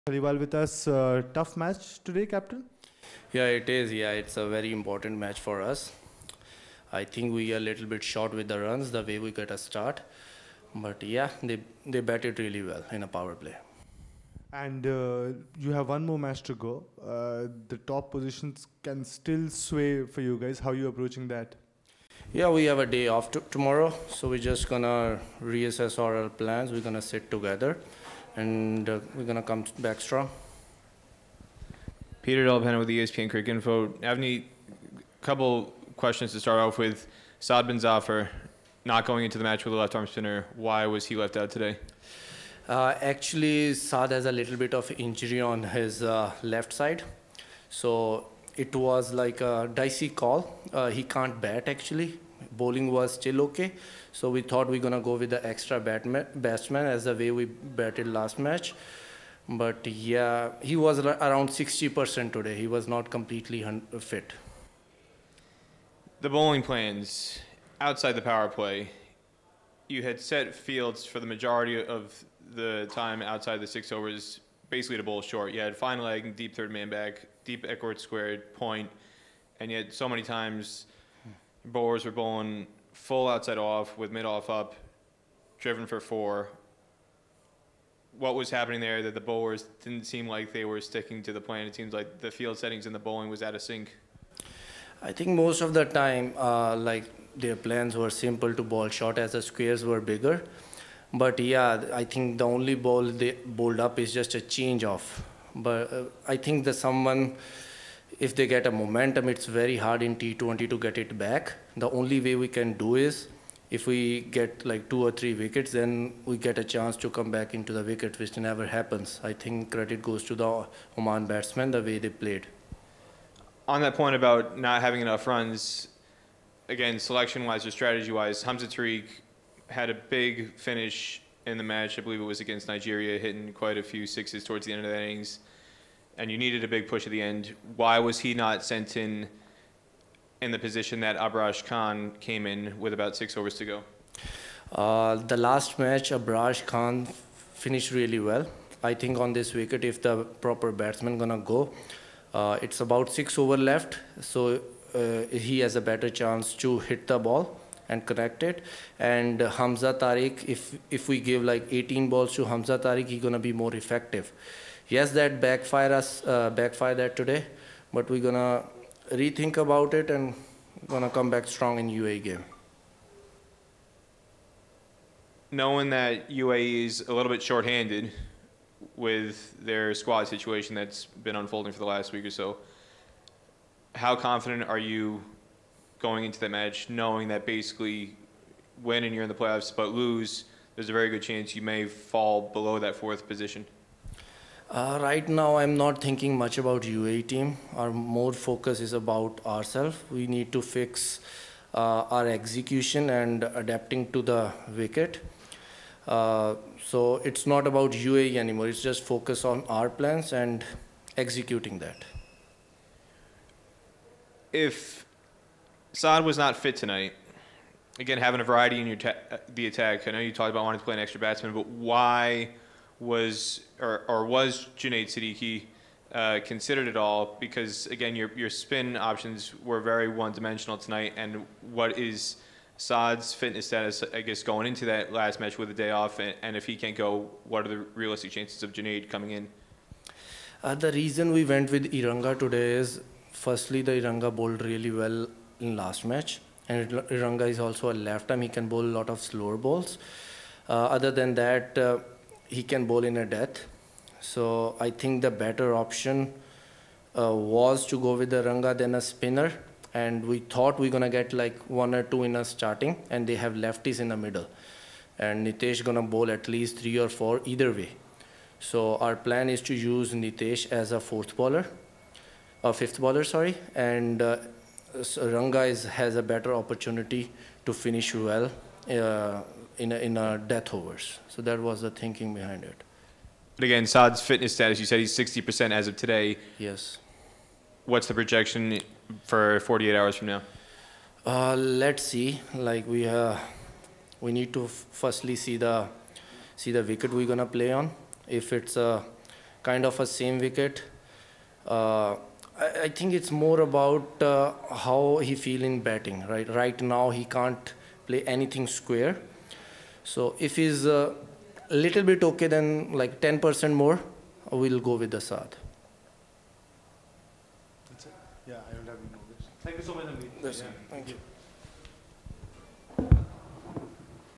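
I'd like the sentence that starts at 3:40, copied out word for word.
I know you talked about wanting to play an extra batsman, but why?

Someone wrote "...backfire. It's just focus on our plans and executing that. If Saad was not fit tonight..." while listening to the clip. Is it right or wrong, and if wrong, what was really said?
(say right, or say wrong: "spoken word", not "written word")
wrong: "anymore", not "backfire".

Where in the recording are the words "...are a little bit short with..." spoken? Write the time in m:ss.
0:07.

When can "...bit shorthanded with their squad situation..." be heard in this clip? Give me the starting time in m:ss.
2:57.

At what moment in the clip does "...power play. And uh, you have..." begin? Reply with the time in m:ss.
0:13.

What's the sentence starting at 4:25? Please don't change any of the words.
And Nitish going to bowl at least three or four either way.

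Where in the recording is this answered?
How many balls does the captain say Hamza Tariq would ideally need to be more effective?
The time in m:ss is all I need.
2:41.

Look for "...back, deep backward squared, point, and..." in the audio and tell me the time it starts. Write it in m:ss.
1:16.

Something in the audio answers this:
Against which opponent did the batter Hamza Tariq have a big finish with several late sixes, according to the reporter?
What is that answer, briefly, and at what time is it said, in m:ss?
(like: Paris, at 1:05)
Nigeria, at 2:12.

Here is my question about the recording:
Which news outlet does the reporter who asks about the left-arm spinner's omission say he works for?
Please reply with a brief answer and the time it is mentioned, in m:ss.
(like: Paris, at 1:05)
ESPNcricinfo, at 0:32.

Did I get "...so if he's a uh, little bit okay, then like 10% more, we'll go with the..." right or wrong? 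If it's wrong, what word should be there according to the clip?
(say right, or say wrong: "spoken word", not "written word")
right.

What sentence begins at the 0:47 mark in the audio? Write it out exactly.
So it was like a dicey call.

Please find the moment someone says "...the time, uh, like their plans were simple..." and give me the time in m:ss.
1:35.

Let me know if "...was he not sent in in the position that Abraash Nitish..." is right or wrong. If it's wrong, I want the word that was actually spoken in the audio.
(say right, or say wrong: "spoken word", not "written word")
wrong: "Khan", not "Nitish".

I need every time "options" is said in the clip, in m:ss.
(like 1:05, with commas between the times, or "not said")
3:48, 4:15.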